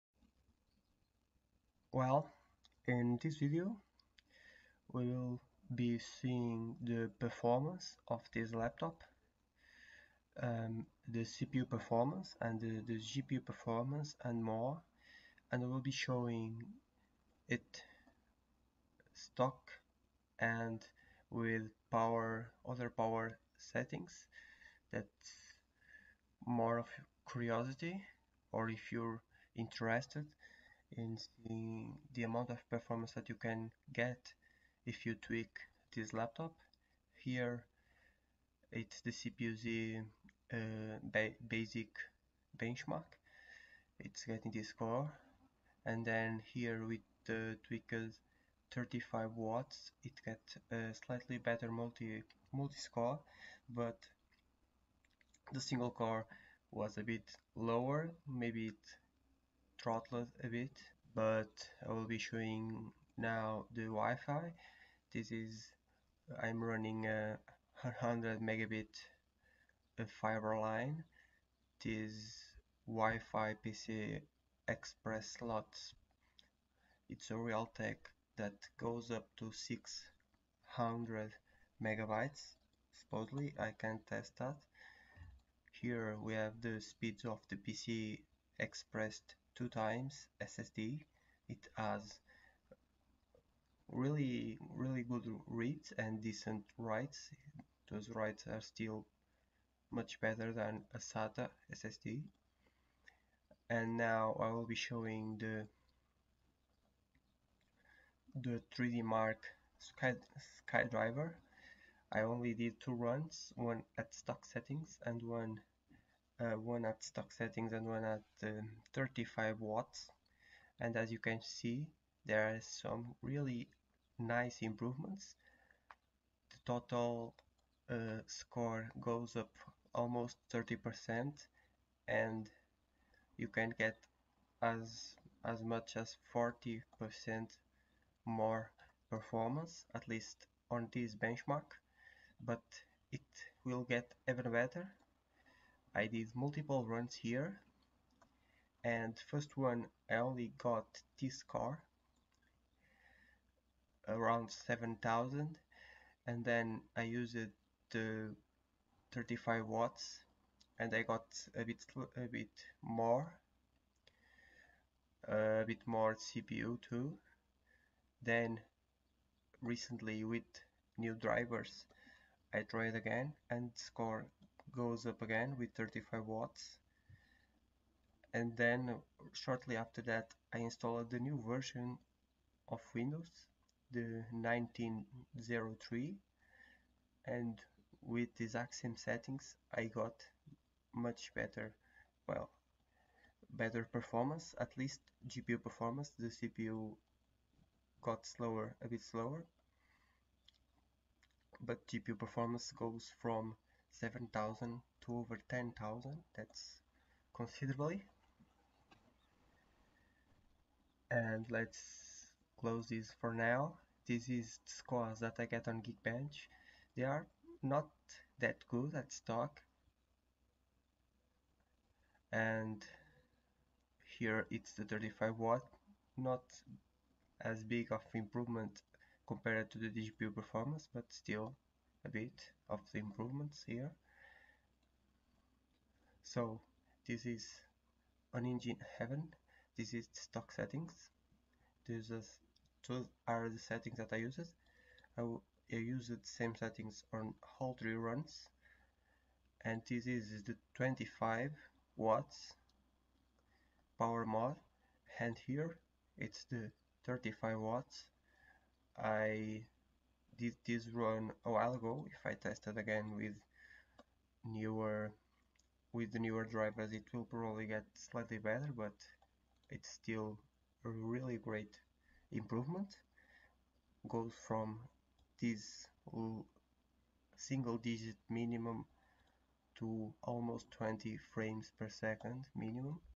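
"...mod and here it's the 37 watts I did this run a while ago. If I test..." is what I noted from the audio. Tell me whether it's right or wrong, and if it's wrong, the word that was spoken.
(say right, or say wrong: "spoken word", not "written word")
wrong: "35", not "37".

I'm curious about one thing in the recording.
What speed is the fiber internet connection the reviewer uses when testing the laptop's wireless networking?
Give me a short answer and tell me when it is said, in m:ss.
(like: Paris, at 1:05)
100 megabit, at 1:07.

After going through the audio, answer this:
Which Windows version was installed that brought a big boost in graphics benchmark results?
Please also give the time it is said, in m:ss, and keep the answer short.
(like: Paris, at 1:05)
1903, at 3:04.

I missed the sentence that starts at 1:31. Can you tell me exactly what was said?
It has really, really good reads and decent writes.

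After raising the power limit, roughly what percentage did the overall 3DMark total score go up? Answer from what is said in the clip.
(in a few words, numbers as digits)
30%.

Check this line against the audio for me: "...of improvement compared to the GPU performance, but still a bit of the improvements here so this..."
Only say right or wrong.
wrong.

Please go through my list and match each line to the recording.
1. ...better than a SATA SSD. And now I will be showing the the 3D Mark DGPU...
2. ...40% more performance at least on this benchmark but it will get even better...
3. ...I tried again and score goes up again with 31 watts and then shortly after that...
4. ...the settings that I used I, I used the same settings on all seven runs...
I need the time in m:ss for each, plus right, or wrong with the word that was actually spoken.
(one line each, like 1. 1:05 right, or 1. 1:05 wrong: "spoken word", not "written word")
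1. 1:40 wrong: "Sky", not "DGPU"
2. 2:16 right
3. 2:52 wrong: "35", not "31"
4. 4:03 wrong: "three", not "seven".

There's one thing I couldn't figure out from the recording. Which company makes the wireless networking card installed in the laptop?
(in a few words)
Realtek.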